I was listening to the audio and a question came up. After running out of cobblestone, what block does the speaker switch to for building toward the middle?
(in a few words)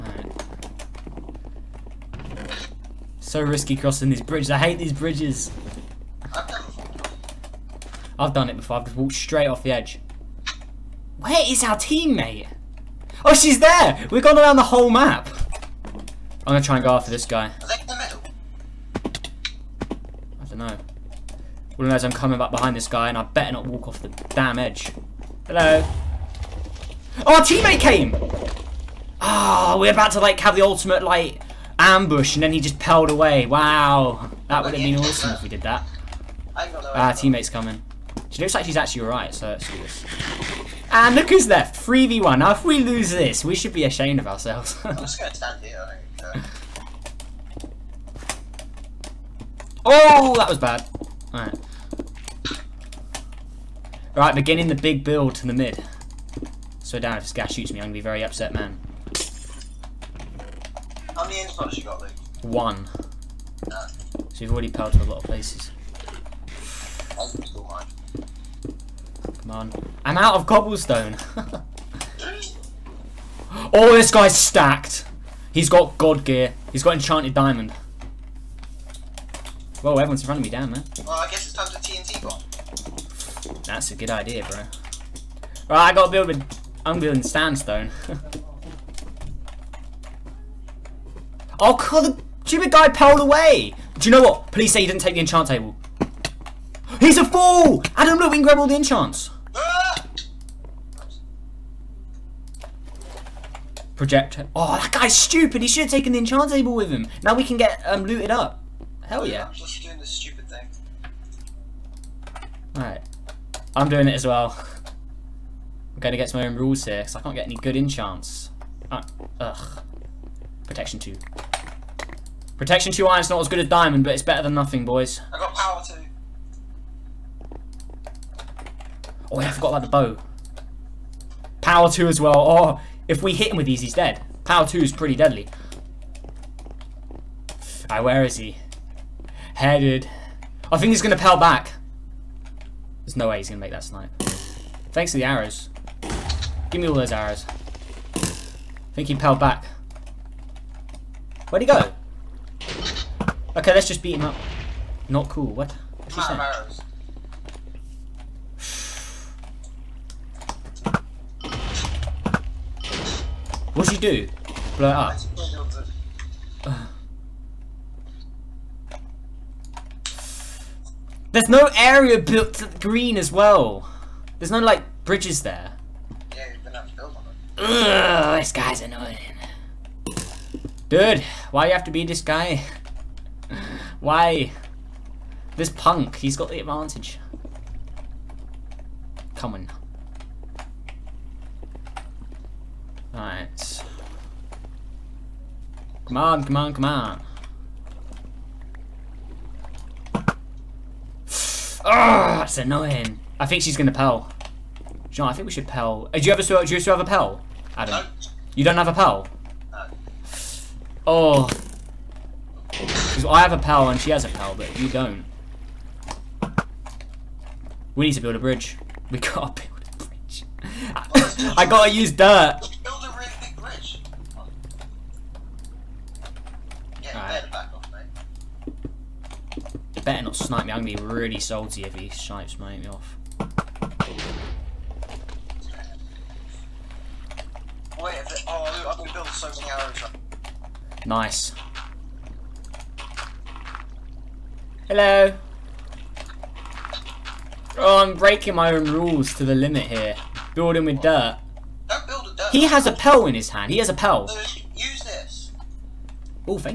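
Sandstone.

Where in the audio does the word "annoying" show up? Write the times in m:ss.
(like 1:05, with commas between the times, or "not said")
2:58, 3:22.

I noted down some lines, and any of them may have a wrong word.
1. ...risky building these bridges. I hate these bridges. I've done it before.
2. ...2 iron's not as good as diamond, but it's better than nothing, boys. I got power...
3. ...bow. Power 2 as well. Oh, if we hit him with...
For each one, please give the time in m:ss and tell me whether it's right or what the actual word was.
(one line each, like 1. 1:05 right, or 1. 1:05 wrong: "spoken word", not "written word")
1. 0:03 wrong: "crossing", not "building"
2. 2:02 right
3. 2:09 right.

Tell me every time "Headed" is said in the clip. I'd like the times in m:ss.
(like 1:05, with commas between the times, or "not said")
2:19.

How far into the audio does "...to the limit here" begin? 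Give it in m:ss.
4:09.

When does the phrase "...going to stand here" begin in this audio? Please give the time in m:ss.
0:45.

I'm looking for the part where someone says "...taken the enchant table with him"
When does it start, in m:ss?
1:45.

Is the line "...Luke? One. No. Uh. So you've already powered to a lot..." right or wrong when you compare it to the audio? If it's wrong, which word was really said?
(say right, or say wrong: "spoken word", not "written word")
right.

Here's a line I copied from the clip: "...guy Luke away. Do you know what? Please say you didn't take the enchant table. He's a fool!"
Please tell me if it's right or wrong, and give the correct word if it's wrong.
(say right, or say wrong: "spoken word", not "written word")
wrong: "Pearled", not "Luke".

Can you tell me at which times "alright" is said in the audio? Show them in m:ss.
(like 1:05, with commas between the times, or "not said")
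0:39, 0:51, 1:52, 2:17, 3:13.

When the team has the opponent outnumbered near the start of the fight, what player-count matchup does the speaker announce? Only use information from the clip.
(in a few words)
3v1.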